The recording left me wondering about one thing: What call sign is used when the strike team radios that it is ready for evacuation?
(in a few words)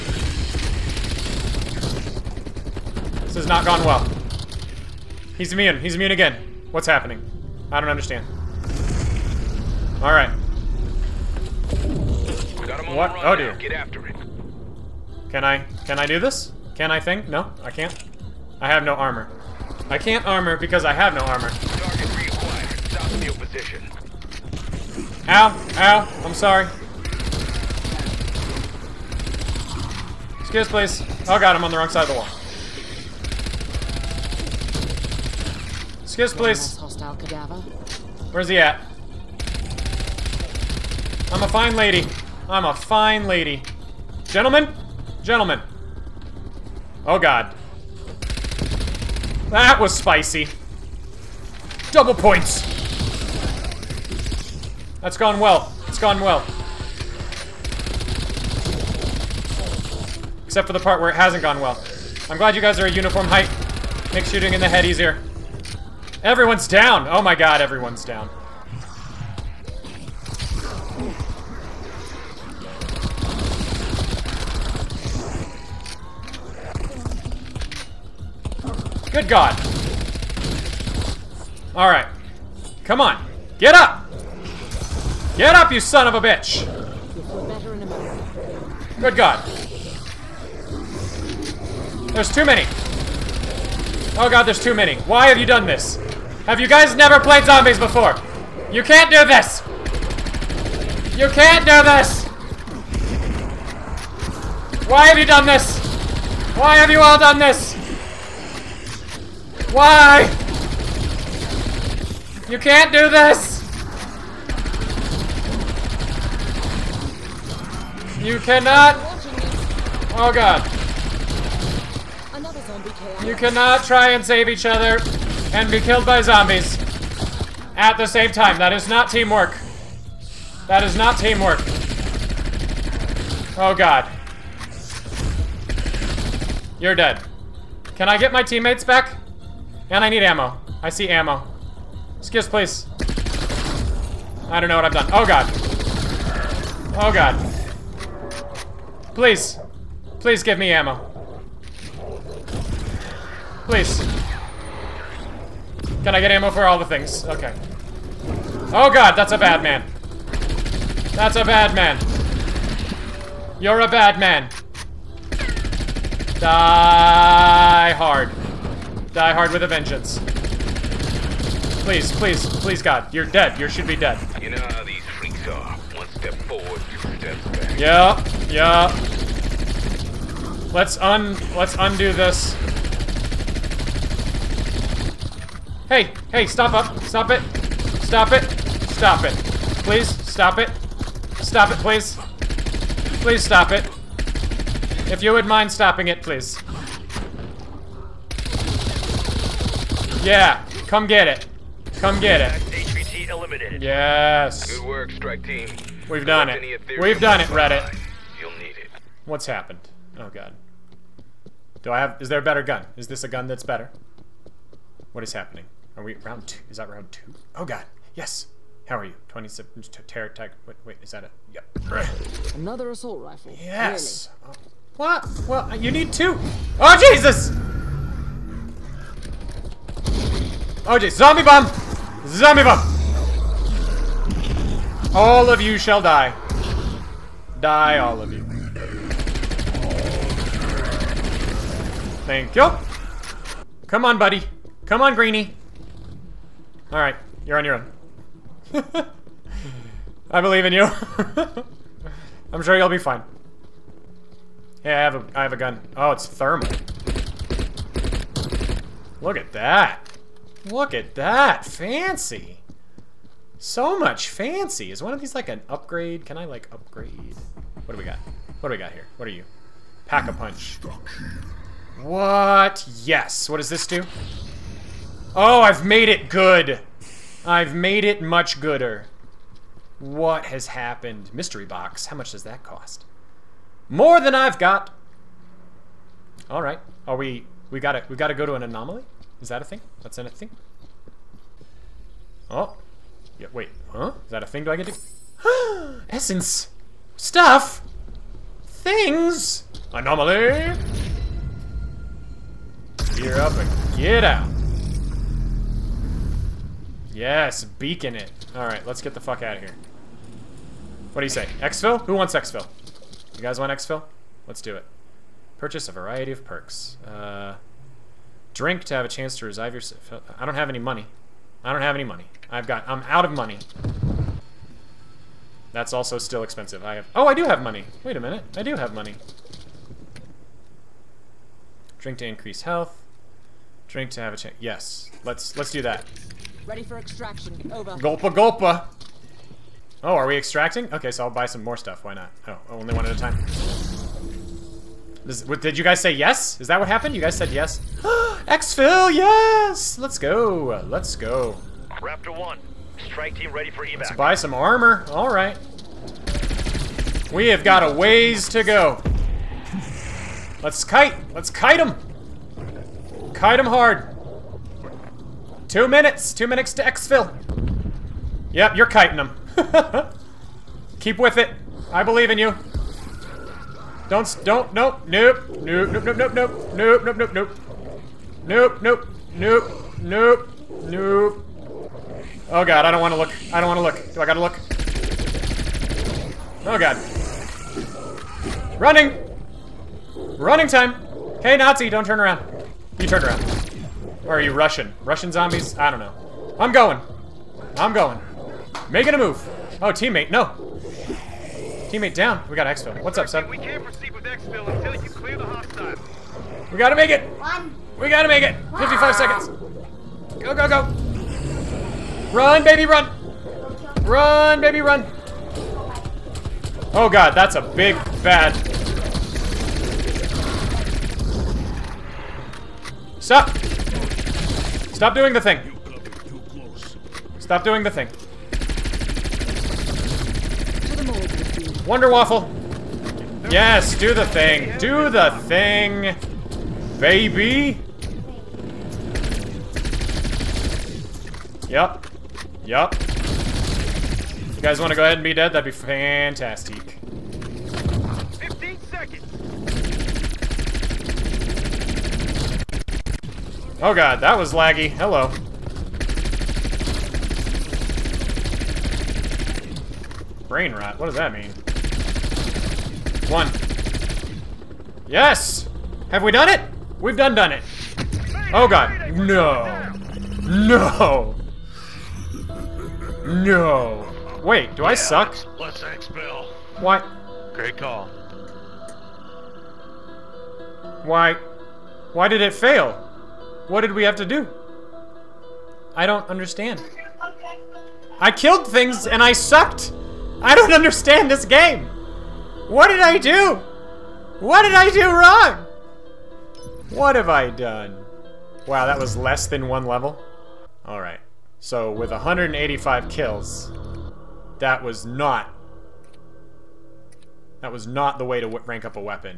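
Raptor 1.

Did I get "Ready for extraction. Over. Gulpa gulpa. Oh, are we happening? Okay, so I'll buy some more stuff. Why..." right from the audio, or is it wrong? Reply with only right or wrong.
wrong.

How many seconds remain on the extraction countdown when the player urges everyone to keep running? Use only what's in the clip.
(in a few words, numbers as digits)
55.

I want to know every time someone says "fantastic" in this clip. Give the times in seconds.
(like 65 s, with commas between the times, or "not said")
445 s.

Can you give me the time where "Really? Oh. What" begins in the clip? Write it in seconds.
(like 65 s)
224 s.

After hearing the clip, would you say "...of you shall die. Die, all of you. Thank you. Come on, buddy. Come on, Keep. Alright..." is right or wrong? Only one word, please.
wrong.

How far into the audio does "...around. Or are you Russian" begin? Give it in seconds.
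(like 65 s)
393 s.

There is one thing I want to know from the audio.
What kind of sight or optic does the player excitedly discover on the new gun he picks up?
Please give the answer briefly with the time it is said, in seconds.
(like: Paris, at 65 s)
Thermal, at 256 s.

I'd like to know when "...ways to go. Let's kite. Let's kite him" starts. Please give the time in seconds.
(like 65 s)
357 s.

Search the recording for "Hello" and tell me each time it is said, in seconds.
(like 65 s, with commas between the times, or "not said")
454 s.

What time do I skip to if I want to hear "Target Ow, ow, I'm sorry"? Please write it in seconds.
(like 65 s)
22 s.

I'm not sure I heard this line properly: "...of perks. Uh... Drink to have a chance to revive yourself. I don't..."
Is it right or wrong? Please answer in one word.
right.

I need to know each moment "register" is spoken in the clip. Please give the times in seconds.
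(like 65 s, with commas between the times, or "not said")
not said.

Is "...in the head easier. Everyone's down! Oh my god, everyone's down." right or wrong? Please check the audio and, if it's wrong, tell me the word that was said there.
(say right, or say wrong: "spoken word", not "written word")
right.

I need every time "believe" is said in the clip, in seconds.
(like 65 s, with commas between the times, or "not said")
250 s, 372 s.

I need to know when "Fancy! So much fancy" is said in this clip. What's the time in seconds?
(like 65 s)
261 s.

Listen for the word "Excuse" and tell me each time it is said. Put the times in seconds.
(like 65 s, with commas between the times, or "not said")
30 s, 36 s, 142 s.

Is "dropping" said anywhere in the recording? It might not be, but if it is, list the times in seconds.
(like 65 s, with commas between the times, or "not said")
not said.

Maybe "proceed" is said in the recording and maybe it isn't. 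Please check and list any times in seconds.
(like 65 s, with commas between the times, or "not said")
403 s.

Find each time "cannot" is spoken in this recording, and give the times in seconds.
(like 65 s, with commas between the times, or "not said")
118 s, 123 s.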